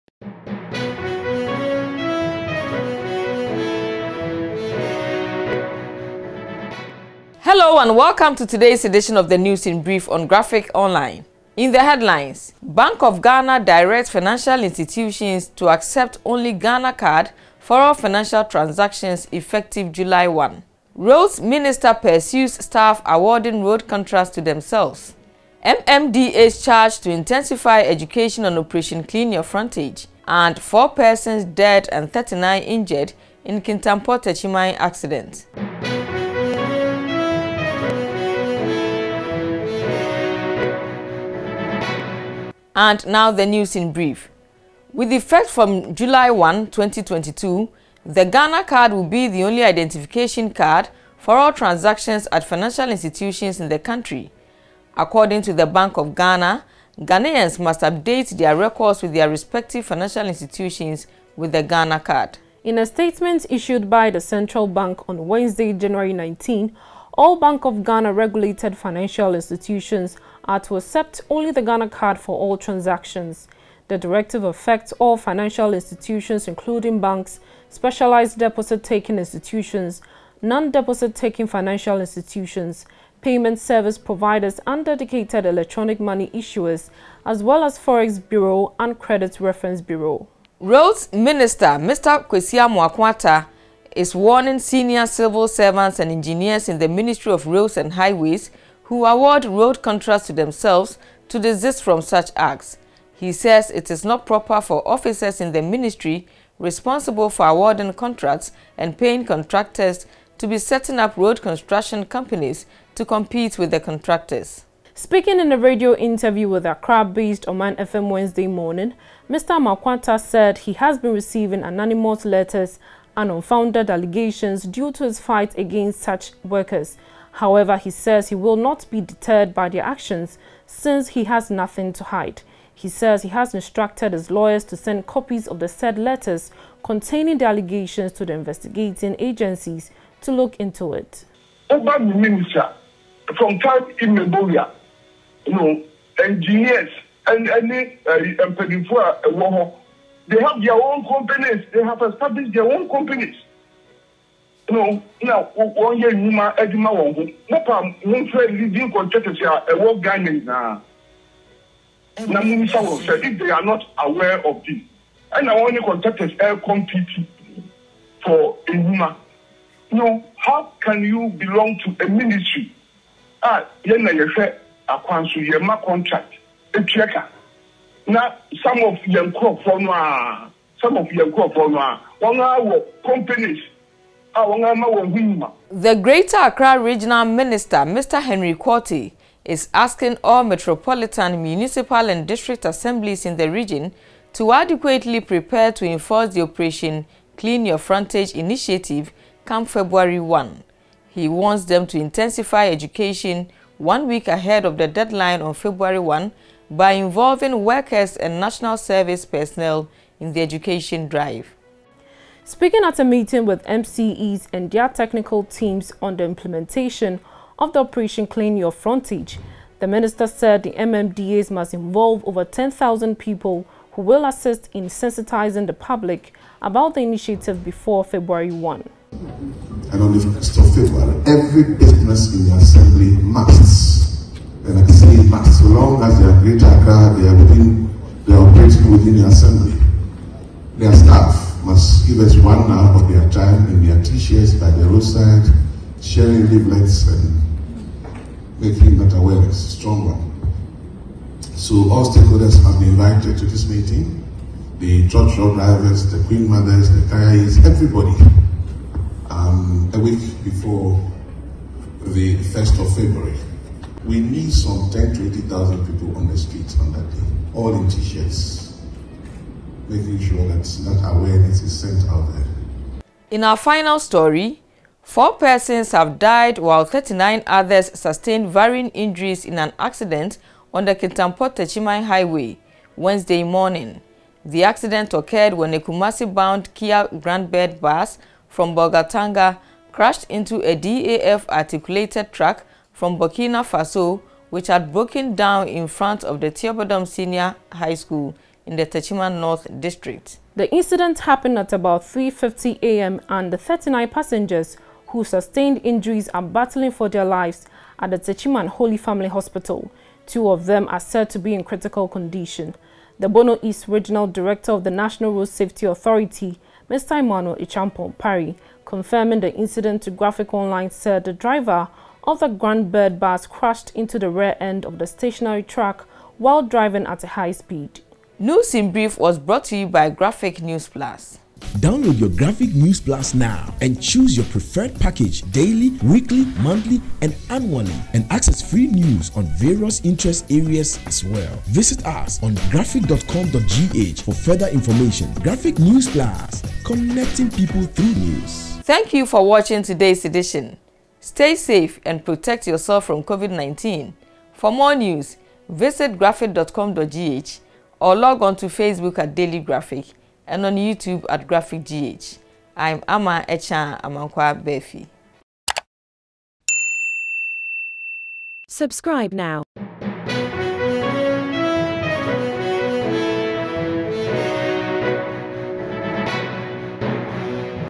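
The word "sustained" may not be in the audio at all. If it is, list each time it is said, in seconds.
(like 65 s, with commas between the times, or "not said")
277 s, 305 s.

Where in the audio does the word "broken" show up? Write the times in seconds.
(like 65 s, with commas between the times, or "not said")
294 s.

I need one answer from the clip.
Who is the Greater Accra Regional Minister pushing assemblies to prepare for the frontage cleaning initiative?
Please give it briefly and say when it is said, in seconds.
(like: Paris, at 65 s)
Henry Quartey, at 188 s.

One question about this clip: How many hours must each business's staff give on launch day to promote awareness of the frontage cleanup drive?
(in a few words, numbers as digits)
1.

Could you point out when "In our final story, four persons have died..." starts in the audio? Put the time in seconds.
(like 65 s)
273 s.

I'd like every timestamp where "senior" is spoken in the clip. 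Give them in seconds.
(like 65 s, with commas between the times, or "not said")
94 s, 297 s.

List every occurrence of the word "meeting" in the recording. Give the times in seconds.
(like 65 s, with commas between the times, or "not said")
213 s, 253 s.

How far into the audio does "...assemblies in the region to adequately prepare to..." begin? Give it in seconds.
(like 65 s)
192 s.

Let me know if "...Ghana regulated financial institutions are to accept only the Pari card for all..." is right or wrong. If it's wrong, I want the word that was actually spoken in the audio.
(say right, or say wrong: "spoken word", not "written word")
wrong: "Ghana", not "Pari".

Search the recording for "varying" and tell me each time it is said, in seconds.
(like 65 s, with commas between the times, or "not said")
278 s.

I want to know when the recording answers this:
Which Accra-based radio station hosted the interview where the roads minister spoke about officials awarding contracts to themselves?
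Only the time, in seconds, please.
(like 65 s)
117 s.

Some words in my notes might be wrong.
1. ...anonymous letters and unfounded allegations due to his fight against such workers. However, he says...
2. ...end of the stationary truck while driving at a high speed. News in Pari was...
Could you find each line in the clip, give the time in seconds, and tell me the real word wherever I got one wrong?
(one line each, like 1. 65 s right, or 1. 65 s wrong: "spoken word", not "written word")
1. 121 s right
2. 324 s wrong: "Brief", not "Pari".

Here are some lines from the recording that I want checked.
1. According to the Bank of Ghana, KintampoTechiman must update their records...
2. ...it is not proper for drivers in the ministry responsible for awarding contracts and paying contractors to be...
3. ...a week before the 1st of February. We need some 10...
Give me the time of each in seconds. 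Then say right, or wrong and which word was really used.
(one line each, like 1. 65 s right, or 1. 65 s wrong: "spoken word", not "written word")
1. 54 s wrong: "Ghanaians", not "KintampoTechiman"
2. 103 s wrong: "officers", not "drivers"
3. 259 s right.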